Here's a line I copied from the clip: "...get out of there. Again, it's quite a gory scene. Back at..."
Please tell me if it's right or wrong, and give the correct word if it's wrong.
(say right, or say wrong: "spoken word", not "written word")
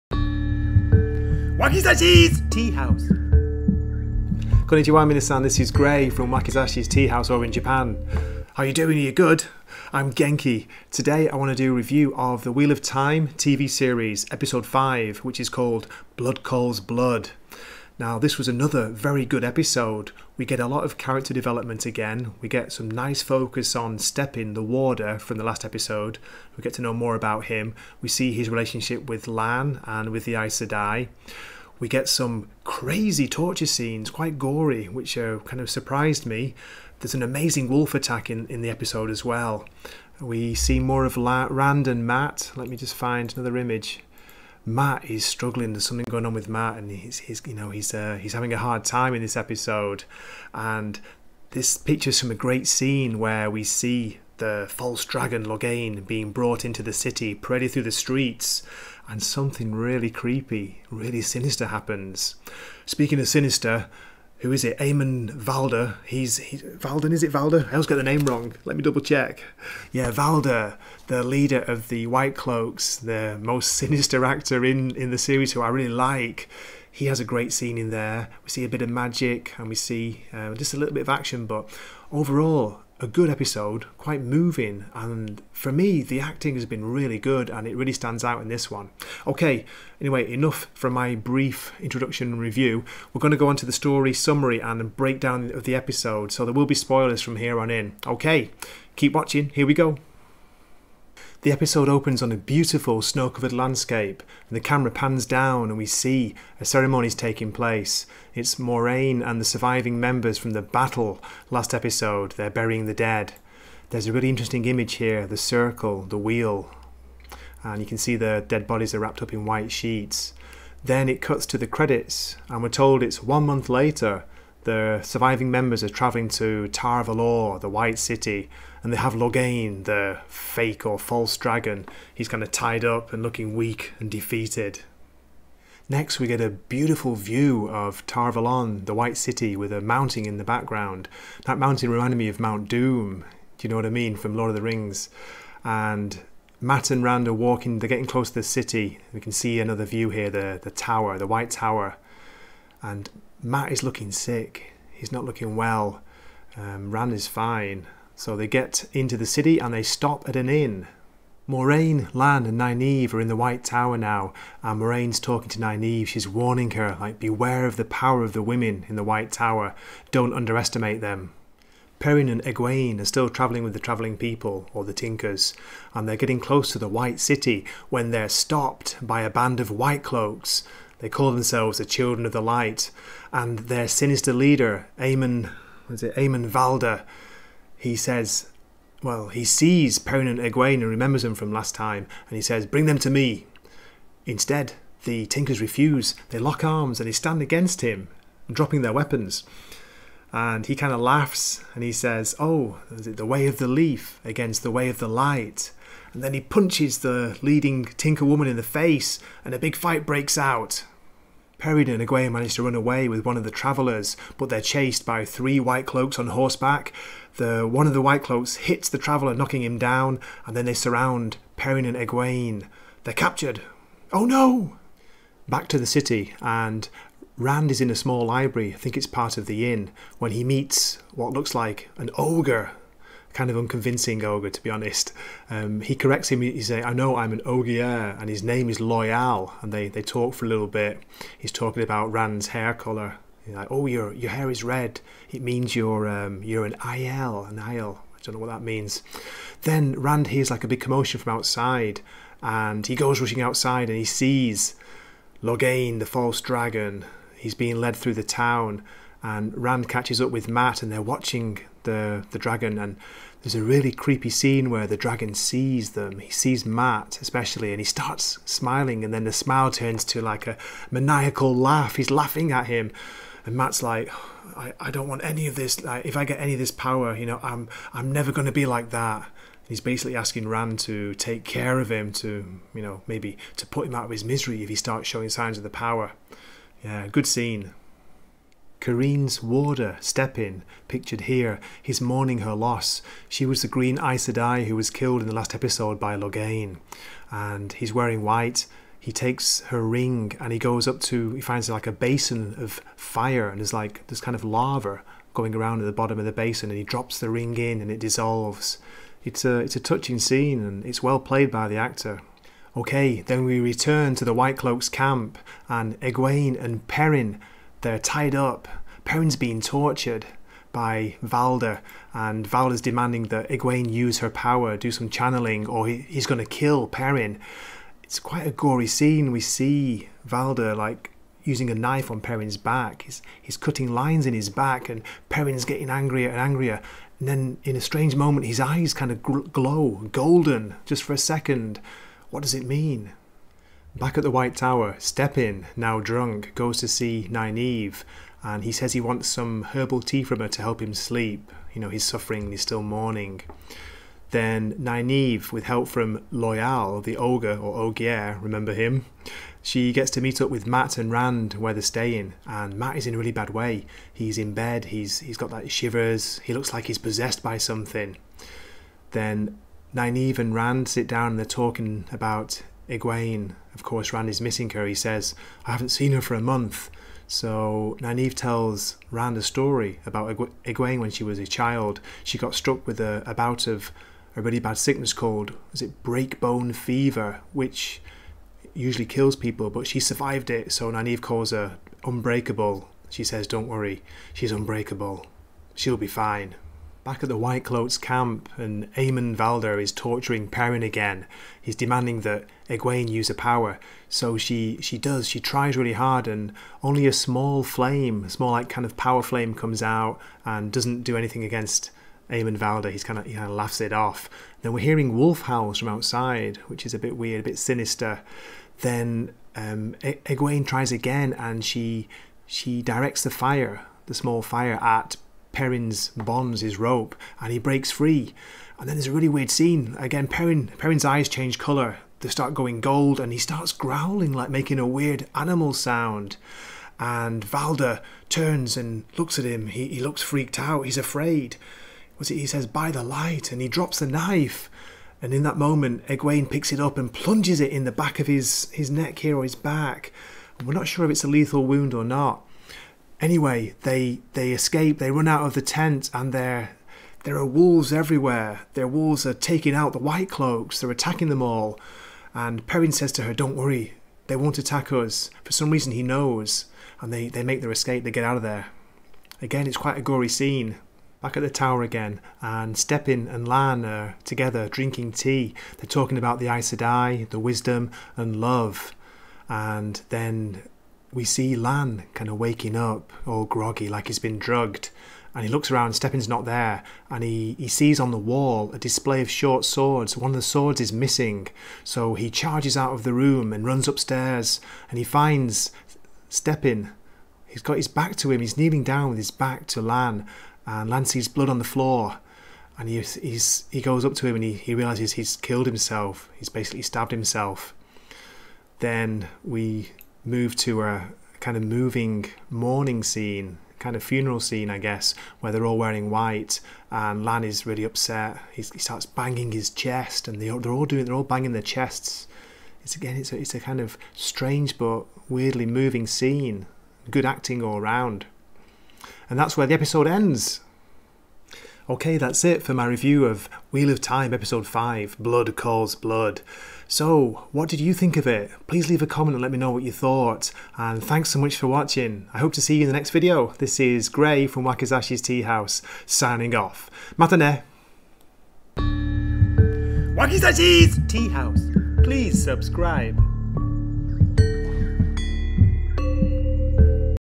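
right.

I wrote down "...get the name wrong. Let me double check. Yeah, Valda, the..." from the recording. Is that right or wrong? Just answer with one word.
right.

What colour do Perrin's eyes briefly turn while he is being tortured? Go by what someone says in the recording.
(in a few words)
Golden.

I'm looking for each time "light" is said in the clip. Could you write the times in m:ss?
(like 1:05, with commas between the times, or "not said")
3:02, 3:25, 7:23.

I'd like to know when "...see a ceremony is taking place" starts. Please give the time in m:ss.
1:45.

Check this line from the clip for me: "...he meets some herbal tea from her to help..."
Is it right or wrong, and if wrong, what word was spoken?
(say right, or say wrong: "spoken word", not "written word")
wrong: "wants", not "meets".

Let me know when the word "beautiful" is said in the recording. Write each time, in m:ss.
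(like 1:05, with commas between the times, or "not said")
1:42, 2:16.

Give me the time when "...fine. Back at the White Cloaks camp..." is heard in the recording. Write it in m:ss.
6:36.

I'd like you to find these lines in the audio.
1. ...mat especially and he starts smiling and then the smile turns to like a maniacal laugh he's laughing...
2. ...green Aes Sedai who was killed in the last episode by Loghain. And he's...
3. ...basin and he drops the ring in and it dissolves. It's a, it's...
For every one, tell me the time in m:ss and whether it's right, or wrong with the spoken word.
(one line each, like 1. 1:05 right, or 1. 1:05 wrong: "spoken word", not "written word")
1. 4:26 right
2. 4:53 right
3. 5:06 right.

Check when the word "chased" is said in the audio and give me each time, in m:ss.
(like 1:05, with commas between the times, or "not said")
3:34.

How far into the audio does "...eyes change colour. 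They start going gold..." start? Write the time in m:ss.
7:11.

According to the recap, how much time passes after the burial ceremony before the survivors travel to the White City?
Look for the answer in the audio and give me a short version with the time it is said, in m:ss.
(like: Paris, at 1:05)
One month, at 2:03.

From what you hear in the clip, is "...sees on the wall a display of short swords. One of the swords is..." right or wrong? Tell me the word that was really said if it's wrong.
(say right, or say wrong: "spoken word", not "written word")
right.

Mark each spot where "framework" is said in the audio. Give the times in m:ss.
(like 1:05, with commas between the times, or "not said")
not said.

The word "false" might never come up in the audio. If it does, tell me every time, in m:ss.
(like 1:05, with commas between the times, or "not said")
0:54, 2:10, 4:16.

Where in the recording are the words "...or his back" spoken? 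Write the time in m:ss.
7:29.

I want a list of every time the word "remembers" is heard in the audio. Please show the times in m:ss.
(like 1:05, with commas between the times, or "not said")
3:10, 5:58.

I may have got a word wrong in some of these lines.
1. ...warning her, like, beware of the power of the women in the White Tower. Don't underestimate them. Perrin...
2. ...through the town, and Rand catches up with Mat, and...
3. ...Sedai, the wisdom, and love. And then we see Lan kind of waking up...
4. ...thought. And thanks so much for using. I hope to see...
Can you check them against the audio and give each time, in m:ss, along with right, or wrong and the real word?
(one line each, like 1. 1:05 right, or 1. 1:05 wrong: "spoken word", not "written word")
1. 2:46 right
2. 4:17 right
3. 7:56 right
4. 8:59 wrong: "watching", not "using".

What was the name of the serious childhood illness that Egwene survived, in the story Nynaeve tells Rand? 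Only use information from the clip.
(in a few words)
Breakbone fever.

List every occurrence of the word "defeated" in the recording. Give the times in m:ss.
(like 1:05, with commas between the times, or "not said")
2:14.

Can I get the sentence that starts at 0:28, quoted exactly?
We see his relationship with Lan and with the Aes Sedai.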